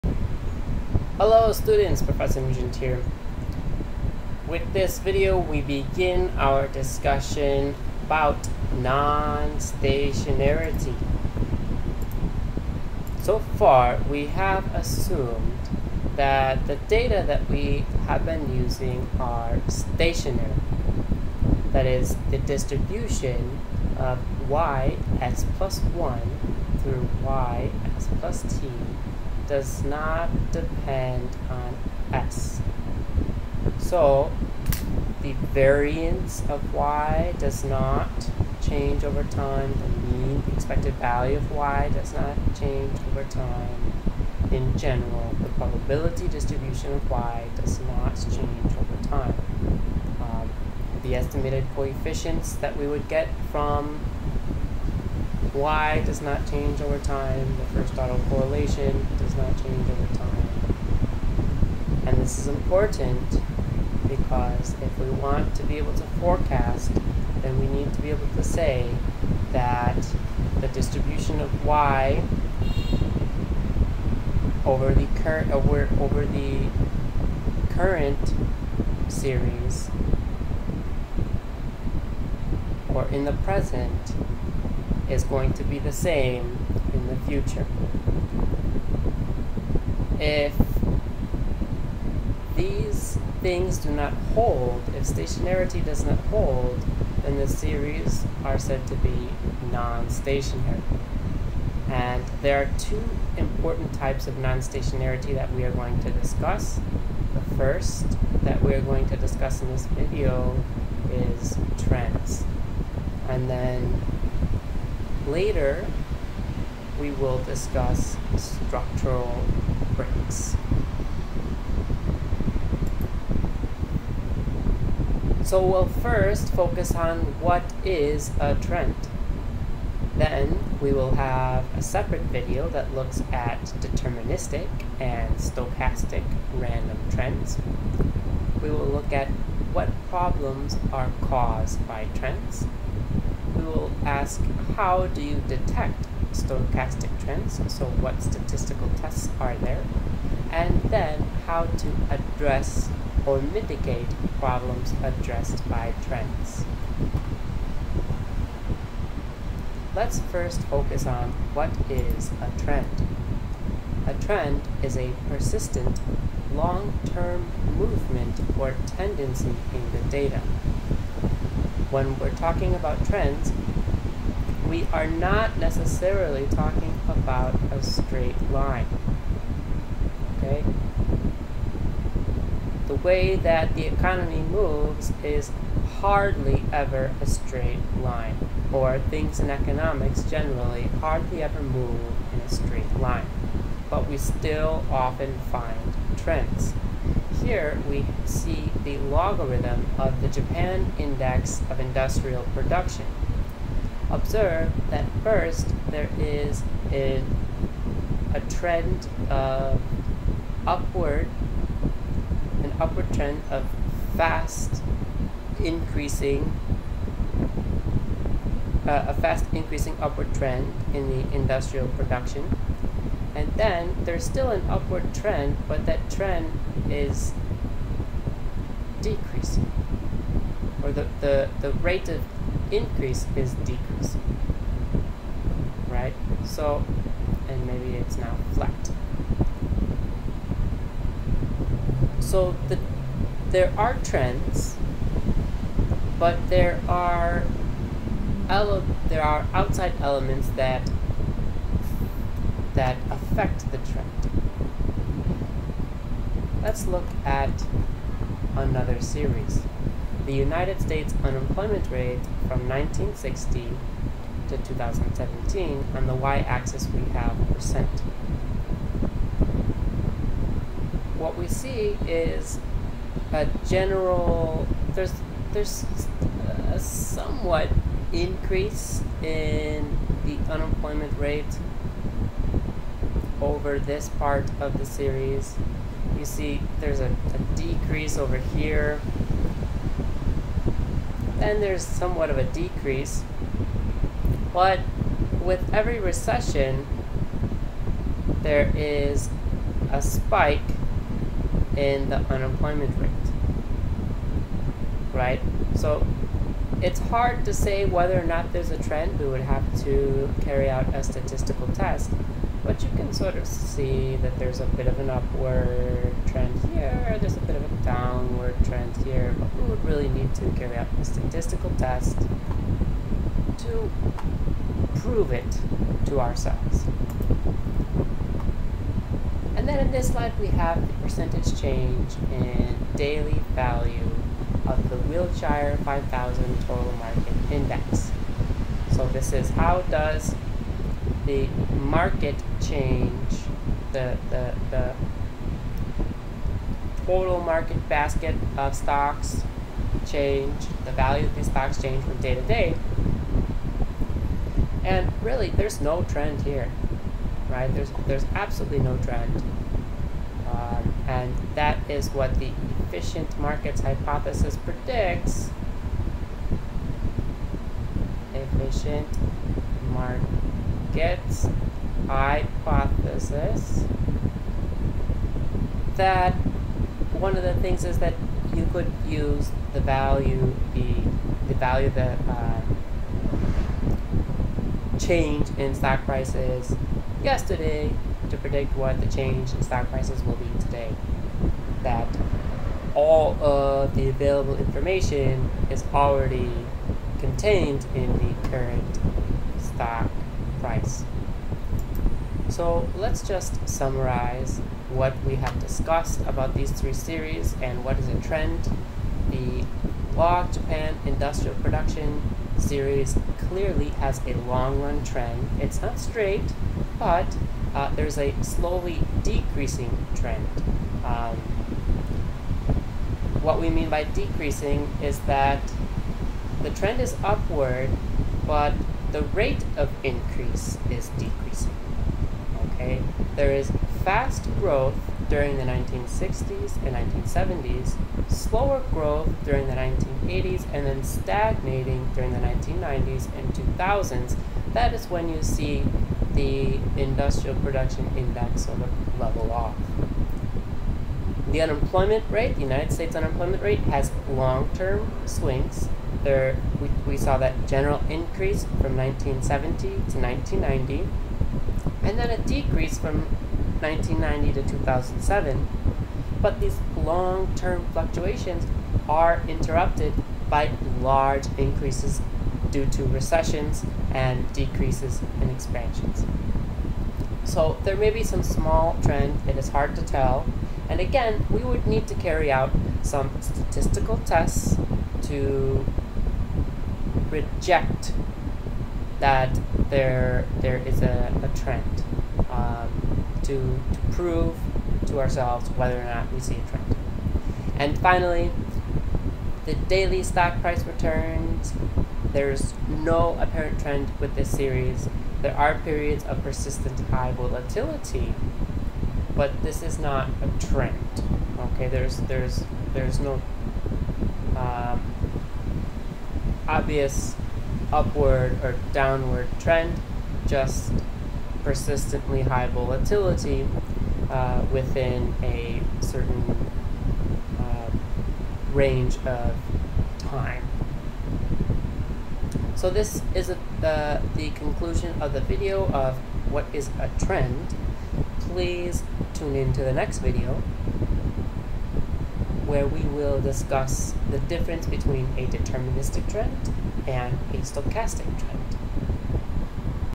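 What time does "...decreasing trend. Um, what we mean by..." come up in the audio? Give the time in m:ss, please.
6:59.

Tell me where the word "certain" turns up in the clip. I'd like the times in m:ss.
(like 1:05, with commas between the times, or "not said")
8:46.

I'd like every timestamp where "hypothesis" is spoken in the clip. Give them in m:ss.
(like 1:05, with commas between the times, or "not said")
6:03, 6:12.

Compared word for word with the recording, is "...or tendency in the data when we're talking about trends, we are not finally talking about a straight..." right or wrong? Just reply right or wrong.
wrong.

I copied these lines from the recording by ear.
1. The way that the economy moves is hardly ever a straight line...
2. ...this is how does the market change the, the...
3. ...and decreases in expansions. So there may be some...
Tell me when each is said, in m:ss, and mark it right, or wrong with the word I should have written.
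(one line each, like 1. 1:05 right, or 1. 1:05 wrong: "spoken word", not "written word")
1. 3:02 right
2. 5:39 right
3. 7:54 right.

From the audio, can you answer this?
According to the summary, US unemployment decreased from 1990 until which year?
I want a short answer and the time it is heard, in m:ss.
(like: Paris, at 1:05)
2007, at 7:44.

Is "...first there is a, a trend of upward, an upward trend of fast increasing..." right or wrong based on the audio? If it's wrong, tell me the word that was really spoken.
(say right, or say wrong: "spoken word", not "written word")
right.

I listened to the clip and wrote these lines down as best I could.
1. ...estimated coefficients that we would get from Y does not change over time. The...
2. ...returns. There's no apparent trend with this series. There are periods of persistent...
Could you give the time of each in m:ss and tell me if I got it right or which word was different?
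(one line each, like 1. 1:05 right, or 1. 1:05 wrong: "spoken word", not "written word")
1. 0:51 right
2. 8:20 right.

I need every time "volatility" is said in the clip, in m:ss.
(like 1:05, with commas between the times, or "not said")
8:27, 8:42.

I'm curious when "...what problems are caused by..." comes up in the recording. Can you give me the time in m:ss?
2:19.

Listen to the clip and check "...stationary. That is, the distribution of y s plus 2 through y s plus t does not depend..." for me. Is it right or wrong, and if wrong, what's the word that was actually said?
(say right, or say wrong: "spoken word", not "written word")
wrong: "1", not "2".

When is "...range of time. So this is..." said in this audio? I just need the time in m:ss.
8:48.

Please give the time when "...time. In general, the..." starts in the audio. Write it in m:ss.
0:43.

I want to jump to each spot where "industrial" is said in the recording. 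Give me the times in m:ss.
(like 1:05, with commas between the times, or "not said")
3:21, 3:41, 6:51, 7:26.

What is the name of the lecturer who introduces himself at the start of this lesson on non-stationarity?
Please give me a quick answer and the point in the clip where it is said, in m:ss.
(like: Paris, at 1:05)
Professor Nugent, at 0:02.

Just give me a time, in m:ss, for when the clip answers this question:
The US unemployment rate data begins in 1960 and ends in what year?
4:24.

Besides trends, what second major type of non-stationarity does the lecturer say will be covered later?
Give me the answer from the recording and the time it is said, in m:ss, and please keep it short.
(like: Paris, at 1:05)
Structural breaks, at 1:58.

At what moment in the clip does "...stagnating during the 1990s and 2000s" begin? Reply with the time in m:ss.
7:21.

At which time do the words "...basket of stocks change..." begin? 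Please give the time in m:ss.
5:47.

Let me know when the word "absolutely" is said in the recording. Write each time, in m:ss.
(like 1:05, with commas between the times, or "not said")
5:58.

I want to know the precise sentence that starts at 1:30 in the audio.
If these things do not hold, if stationarity does not hold, then the series are said to be non-stationary.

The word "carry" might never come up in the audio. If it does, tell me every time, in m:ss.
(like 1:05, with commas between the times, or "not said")
5:10, 5:20, 8:02.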